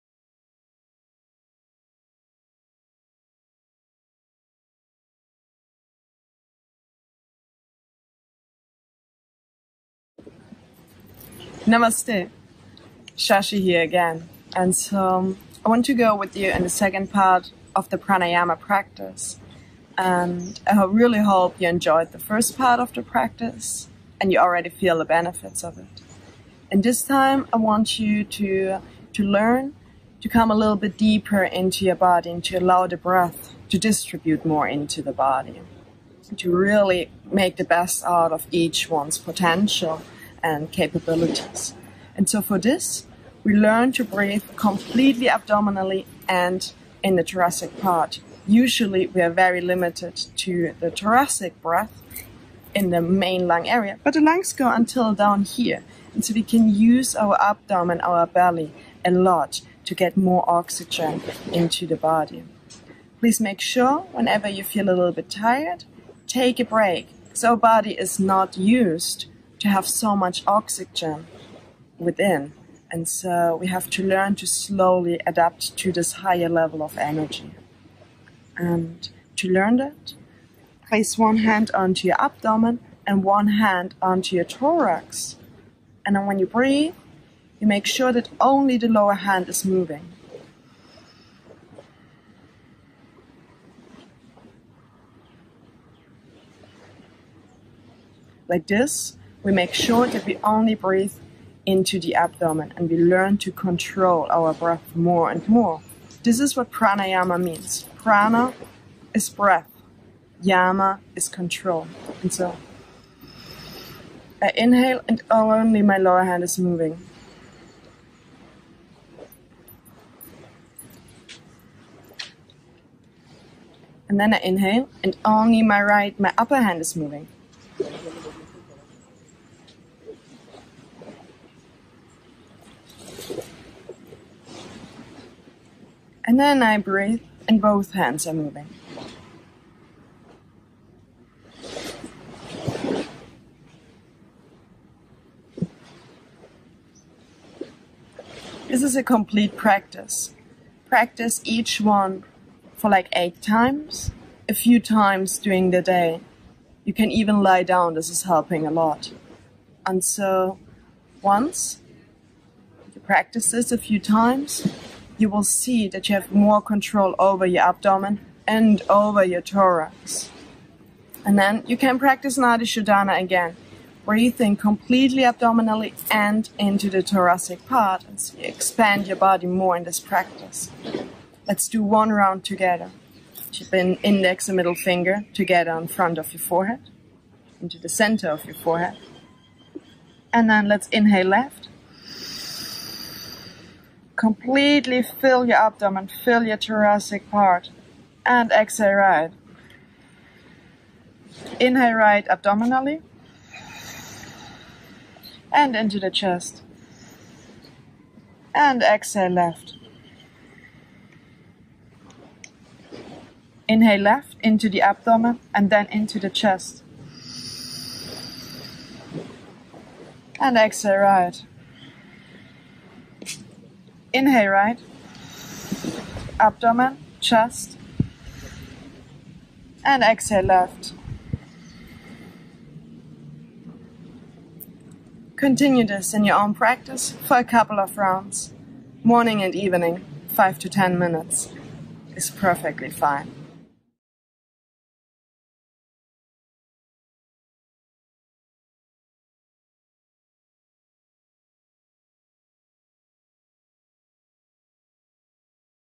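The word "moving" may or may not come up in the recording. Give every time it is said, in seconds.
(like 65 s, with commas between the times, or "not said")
89 s, 116 s, 126 s, 138 s.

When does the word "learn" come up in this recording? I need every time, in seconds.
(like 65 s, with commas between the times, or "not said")
29 s, 43 s, 74 s, 79 s, 102 s.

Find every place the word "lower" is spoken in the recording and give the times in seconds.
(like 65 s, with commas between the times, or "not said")
88 s, 115 s.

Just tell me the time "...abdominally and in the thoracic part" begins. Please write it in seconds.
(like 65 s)
45 s.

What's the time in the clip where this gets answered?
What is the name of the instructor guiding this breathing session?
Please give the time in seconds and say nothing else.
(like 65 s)
13 s.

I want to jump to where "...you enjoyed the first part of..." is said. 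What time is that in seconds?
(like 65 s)
21 s.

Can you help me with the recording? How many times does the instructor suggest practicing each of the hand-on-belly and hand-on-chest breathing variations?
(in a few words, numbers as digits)
8.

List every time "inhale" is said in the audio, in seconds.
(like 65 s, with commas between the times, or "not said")
114 s, 124 s, 190 s, 201 s, 213 s, 224 s.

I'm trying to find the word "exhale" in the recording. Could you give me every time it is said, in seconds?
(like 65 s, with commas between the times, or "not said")
198 s, 208 s, 220 s, 230 s.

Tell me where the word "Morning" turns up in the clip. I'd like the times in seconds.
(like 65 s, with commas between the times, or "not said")
239 s.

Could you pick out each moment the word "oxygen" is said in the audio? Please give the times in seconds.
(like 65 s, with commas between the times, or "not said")
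60 s, 70 s.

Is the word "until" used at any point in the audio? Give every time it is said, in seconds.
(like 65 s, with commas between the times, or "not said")
54 s.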